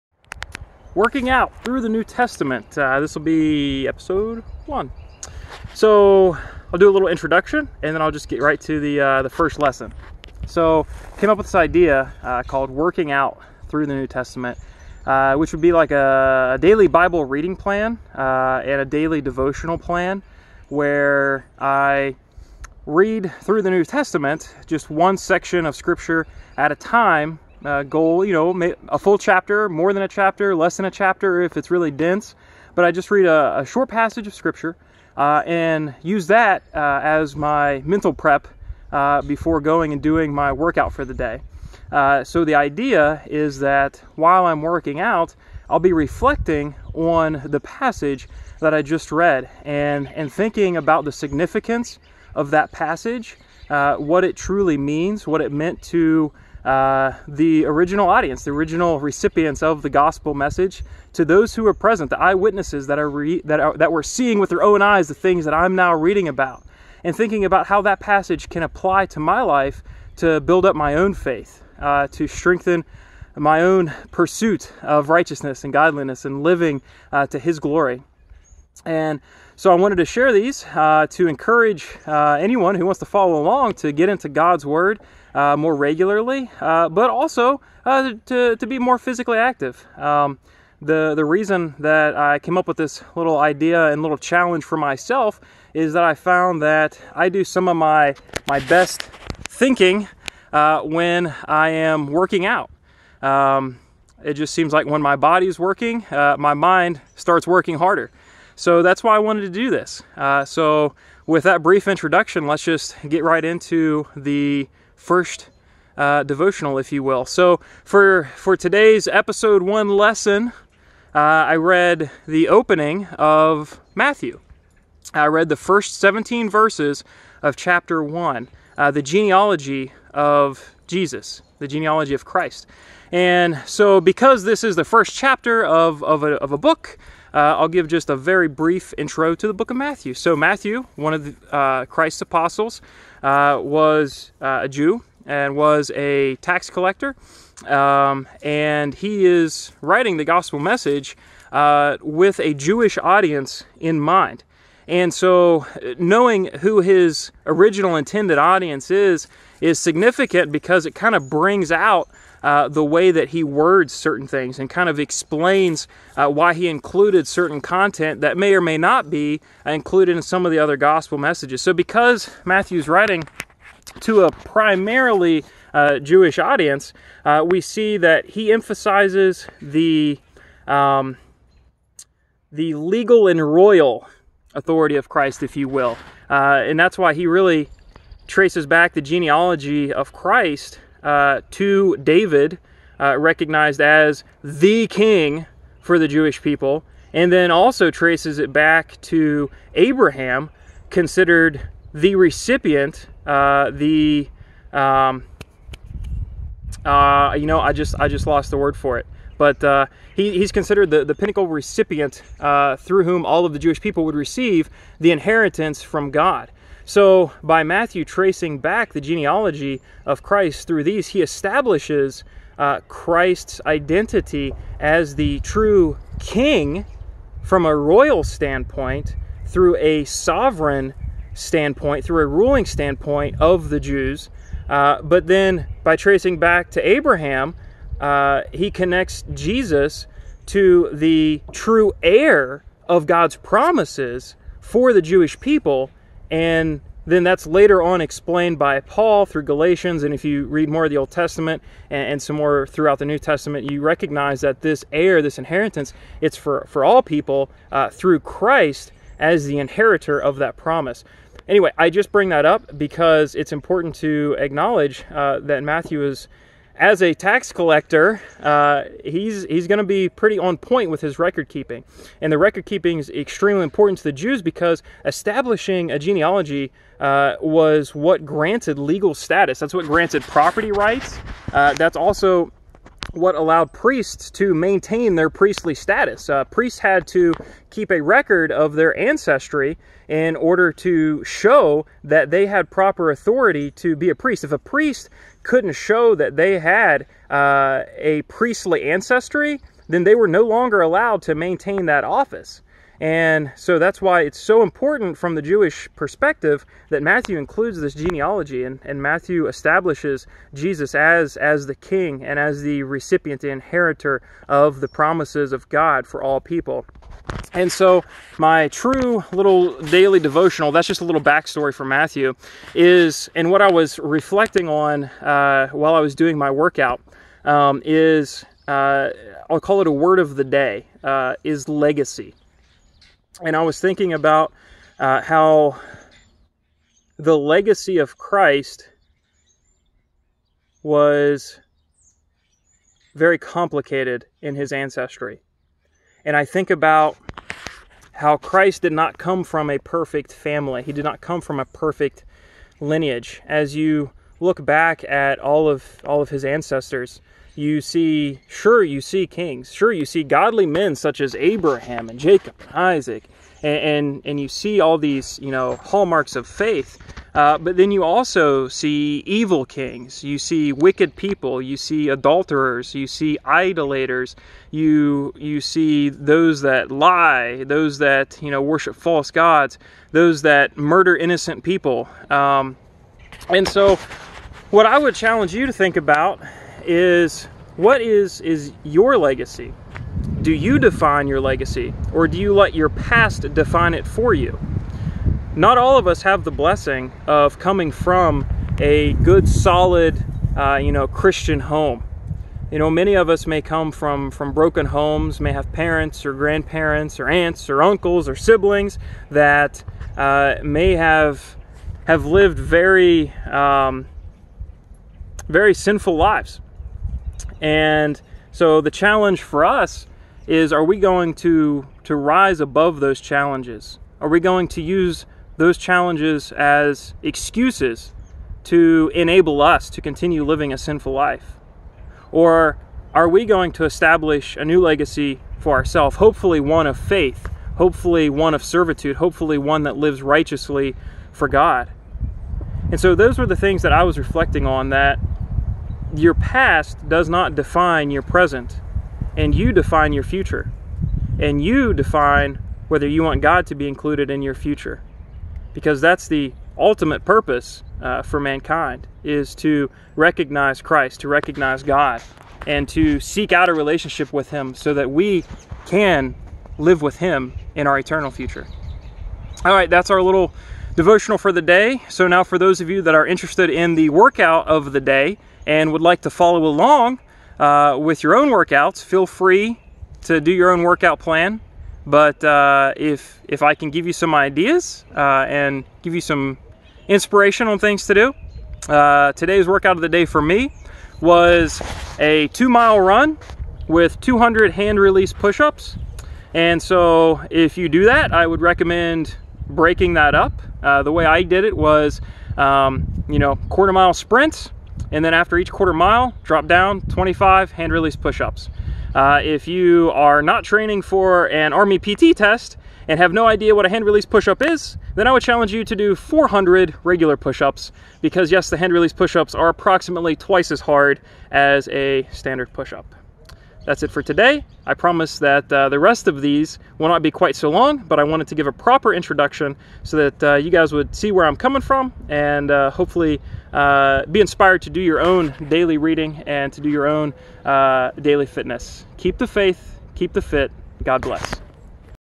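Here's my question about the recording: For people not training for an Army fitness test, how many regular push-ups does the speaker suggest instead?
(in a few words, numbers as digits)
400.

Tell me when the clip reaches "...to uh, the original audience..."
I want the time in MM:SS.
00:55.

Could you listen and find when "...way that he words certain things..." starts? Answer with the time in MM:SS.
02:42.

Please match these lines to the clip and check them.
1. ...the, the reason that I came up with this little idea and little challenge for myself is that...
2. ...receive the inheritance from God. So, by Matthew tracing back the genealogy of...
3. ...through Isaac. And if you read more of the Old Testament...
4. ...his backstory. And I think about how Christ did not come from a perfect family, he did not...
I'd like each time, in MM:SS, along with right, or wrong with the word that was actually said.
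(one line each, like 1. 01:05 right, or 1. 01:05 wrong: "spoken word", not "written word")
1. 01:30 right
2. 03:34 right
3. 04:09 wrong: "Galatians", not "Isaac"
4. 05:44 wrong: "ancestry", not "backstory".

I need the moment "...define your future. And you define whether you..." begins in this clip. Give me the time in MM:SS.
07:29.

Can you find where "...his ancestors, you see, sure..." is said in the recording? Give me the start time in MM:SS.
05:56.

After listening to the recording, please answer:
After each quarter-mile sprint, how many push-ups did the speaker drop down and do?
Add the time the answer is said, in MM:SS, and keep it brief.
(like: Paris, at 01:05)
25, at 08:27.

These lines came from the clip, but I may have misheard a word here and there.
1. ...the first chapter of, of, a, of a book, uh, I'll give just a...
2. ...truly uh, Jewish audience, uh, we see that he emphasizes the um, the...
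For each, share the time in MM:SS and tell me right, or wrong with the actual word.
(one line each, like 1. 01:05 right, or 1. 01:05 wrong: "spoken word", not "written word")
1. 02:14 right
2. 02:54 wrong: "primarily", not "truly".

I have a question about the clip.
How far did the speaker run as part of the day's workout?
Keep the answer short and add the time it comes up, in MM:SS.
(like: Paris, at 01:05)
2 miles, at 08:12.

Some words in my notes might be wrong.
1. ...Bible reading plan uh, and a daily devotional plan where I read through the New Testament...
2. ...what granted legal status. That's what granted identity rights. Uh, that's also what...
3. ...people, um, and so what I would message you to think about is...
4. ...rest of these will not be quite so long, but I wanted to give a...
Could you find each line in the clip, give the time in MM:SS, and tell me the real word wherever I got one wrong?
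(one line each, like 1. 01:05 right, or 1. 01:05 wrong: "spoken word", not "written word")
1. 00:16 right
2. 04:37 wrong: "property", not "identity"
3. 06:21 wrong: "challenge", not "message"
4. 08:45 right.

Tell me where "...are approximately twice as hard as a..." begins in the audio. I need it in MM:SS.
08:39.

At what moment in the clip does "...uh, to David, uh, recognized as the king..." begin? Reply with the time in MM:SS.
03:11.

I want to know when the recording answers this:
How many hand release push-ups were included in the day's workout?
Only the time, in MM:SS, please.
08:14.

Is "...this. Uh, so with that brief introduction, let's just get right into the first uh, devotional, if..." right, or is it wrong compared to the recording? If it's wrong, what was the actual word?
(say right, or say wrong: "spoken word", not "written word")
right.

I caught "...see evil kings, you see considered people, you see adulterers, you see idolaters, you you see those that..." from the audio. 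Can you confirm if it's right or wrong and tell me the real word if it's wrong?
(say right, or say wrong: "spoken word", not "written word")
wrong: "wicked", not "considered".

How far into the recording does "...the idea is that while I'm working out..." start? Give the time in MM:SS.
00:42.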